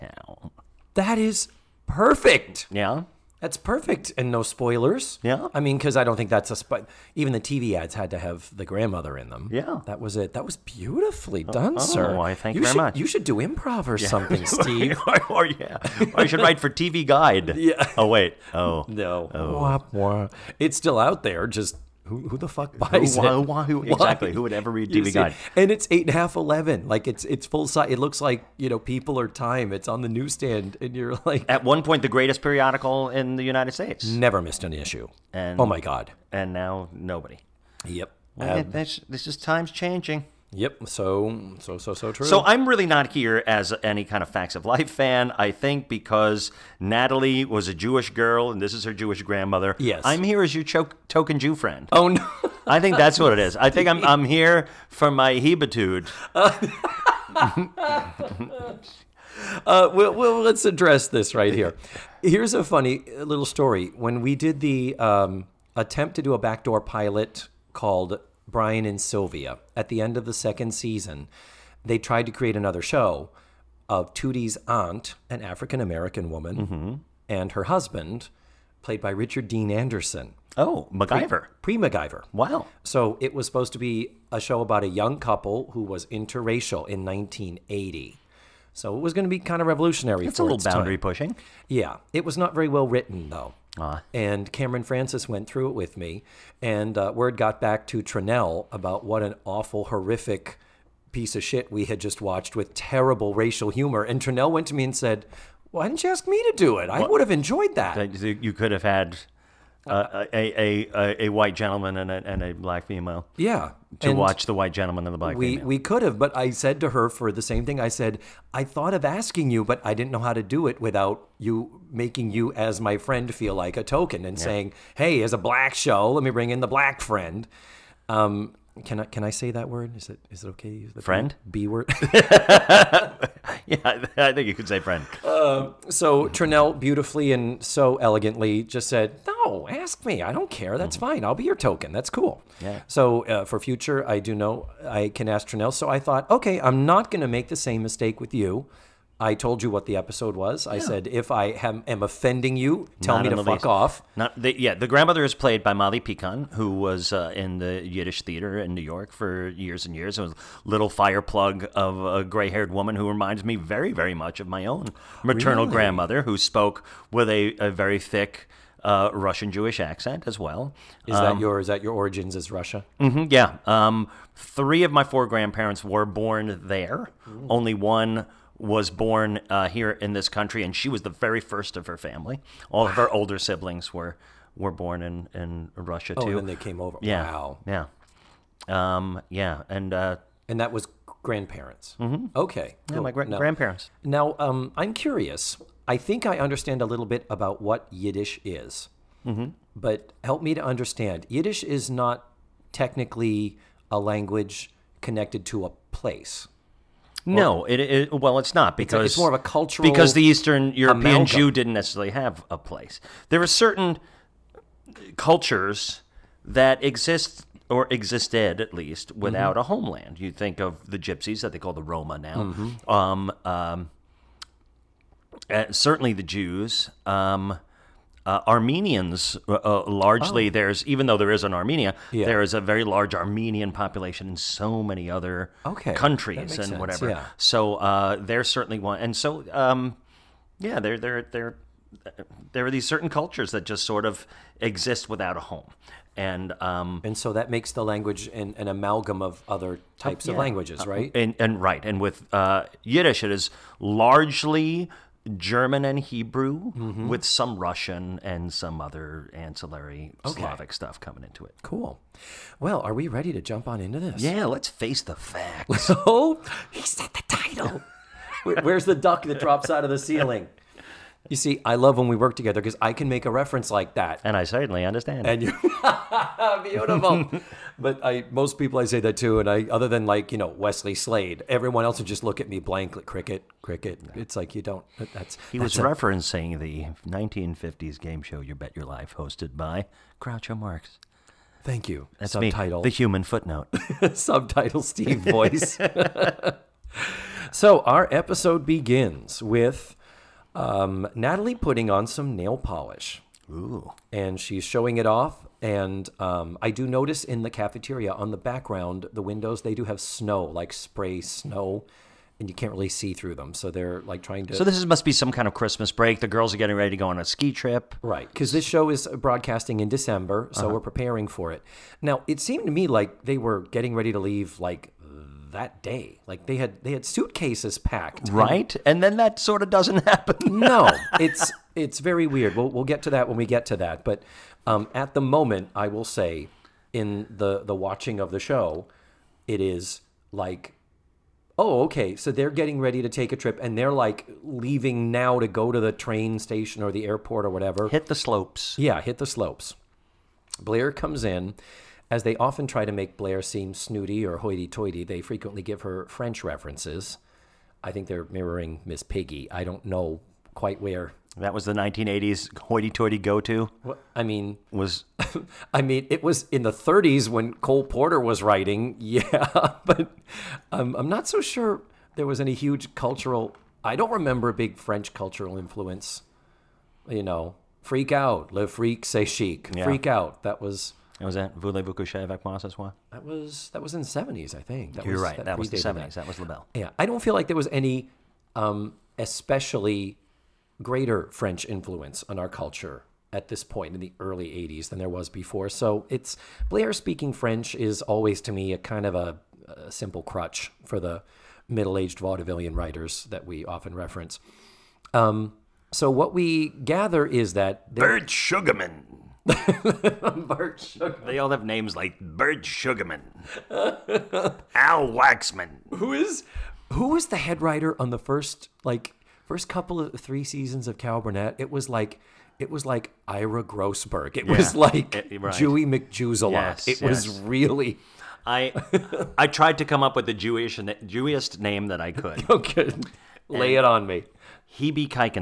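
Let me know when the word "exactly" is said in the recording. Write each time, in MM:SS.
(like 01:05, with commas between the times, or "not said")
00:23.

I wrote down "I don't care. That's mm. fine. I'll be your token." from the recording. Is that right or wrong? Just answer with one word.
right.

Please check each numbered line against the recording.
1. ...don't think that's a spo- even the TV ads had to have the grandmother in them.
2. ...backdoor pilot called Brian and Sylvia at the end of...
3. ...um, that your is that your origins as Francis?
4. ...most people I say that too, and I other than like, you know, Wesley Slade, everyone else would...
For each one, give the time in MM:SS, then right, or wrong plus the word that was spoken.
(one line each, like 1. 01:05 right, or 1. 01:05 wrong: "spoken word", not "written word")
1. 00:06 right
2. 01:06 right
3. 02:51 wrong: "Russia", not "Francis"
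4. 04:38 right.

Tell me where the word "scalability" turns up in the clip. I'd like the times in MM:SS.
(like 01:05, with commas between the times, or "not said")
not said.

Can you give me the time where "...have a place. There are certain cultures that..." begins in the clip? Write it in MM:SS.
03:32.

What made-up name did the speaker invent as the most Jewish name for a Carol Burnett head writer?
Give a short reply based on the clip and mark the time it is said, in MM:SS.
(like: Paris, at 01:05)
Ira Grossberg, at 07:03.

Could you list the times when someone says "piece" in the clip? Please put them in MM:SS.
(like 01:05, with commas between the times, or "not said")
01:41.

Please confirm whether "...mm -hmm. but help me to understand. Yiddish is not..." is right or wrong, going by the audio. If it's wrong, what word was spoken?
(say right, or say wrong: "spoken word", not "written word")
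right.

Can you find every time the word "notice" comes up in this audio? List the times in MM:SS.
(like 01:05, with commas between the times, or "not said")
05:06.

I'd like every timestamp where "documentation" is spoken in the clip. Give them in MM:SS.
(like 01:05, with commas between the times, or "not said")
not said.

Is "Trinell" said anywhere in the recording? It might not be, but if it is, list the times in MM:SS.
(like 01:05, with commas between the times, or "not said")
01:38, 01:44, 02:16, 02:25.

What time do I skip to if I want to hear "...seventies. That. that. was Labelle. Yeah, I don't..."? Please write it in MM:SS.
06:25.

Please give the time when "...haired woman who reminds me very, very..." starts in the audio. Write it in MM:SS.
02:42.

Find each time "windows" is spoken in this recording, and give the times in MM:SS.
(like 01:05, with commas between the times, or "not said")
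05:09.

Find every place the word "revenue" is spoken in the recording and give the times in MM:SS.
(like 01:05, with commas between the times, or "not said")
not said.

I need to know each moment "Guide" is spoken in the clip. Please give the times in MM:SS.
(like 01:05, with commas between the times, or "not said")
00:17, 00:25.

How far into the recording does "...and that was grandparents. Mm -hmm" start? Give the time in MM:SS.
03:10.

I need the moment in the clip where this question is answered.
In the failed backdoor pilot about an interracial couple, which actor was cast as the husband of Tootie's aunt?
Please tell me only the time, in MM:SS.
01:19.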